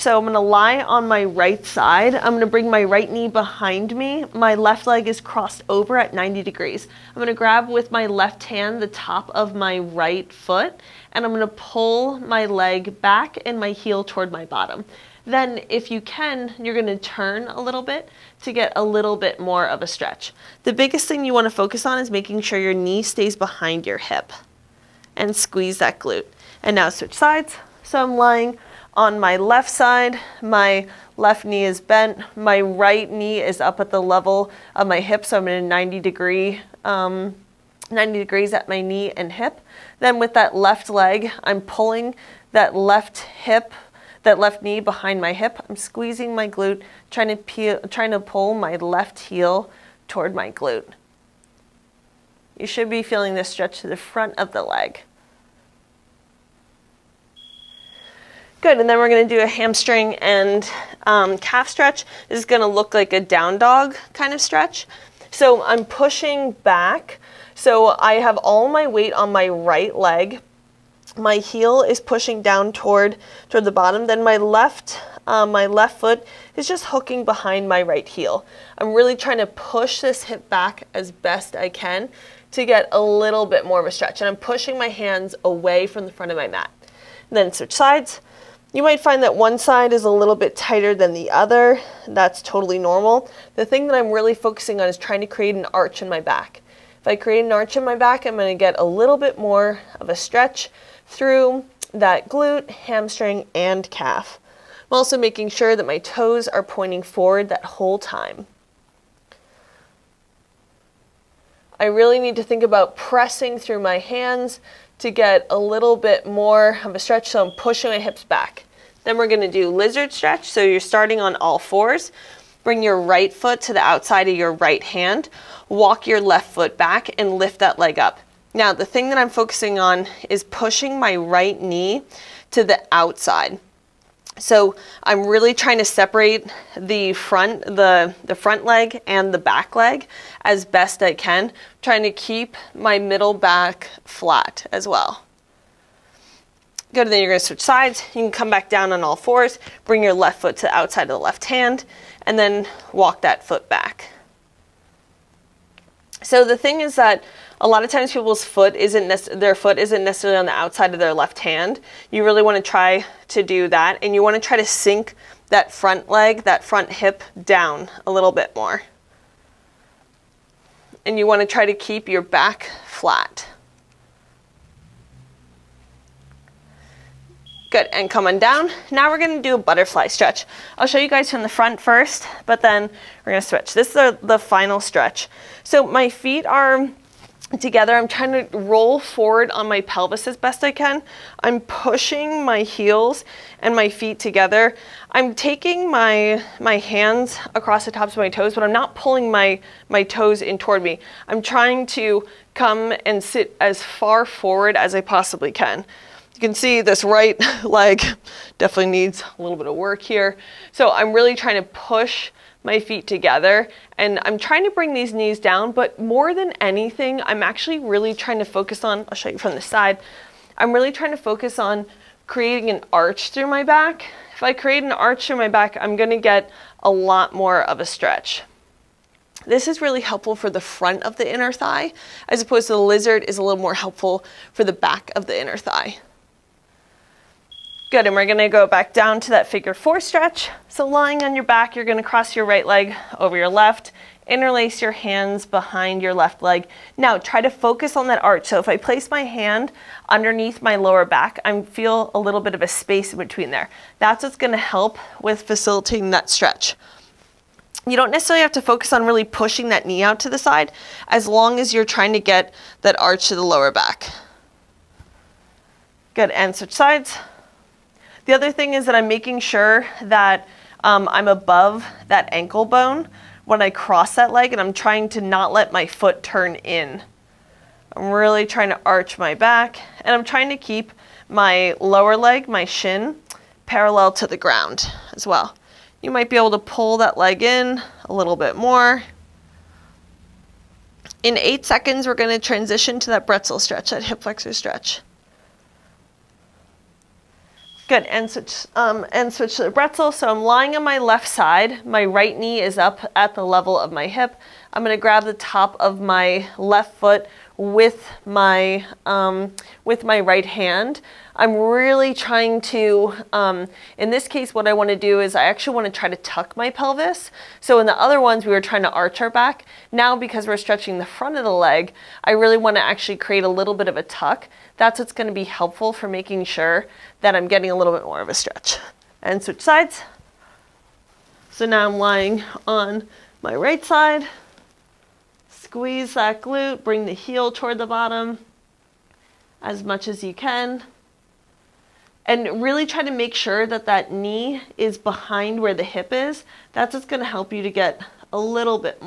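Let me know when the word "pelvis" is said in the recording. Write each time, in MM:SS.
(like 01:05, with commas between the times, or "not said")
03:09, 05:16.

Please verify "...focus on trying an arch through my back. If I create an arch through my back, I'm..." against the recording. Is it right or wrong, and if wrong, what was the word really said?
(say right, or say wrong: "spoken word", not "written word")
wrong: "creating", not "trying".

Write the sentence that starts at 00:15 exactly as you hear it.
Then if you can, you're going to turn a little bit to get a little bit more of a stretch.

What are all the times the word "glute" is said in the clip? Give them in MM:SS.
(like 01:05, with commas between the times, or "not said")
00:25, 00:46, 00:50, 01:42, 05:36.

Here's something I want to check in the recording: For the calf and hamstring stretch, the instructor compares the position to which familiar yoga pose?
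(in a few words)
down dog.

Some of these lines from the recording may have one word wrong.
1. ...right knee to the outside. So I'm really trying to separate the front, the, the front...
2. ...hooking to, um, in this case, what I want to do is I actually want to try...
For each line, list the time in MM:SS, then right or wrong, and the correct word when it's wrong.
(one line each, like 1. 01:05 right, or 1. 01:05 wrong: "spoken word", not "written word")
1. 02:11 right
2. 05:12 wrong: "trying", not "hooking".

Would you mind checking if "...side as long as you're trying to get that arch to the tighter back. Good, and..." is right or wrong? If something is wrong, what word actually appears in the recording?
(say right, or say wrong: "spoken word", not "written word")
wrong: "lower", not "tighter".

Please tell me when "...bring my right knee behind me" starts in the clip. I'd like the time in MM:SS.
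00:02.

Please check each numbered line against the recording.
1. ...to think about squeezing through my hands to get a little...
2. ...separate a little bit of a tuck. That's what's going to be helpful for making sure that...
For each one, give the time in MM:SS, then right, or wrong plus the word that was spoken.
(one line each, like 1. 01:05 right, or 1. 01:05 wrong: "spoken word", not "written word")
1. 01:52 wrong: "pressing", not "squeezing"
2. 05:23 wrong: "create", not "separate".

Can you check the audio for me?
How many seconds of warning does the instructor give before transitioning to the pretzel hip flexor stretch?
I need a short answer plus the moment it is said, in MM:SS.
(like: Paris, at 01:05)
8, at 04:51.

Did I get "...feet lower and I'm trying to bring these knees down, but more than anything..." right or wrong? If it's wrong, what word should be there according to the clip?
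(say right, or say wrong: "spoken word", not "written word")
wrong: "together", not "lower".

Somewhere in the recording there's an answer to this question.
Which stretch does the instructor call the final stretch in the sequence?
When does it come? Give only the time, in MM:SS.
02:59.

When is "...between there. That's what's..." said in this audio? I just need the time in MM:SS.
04:13.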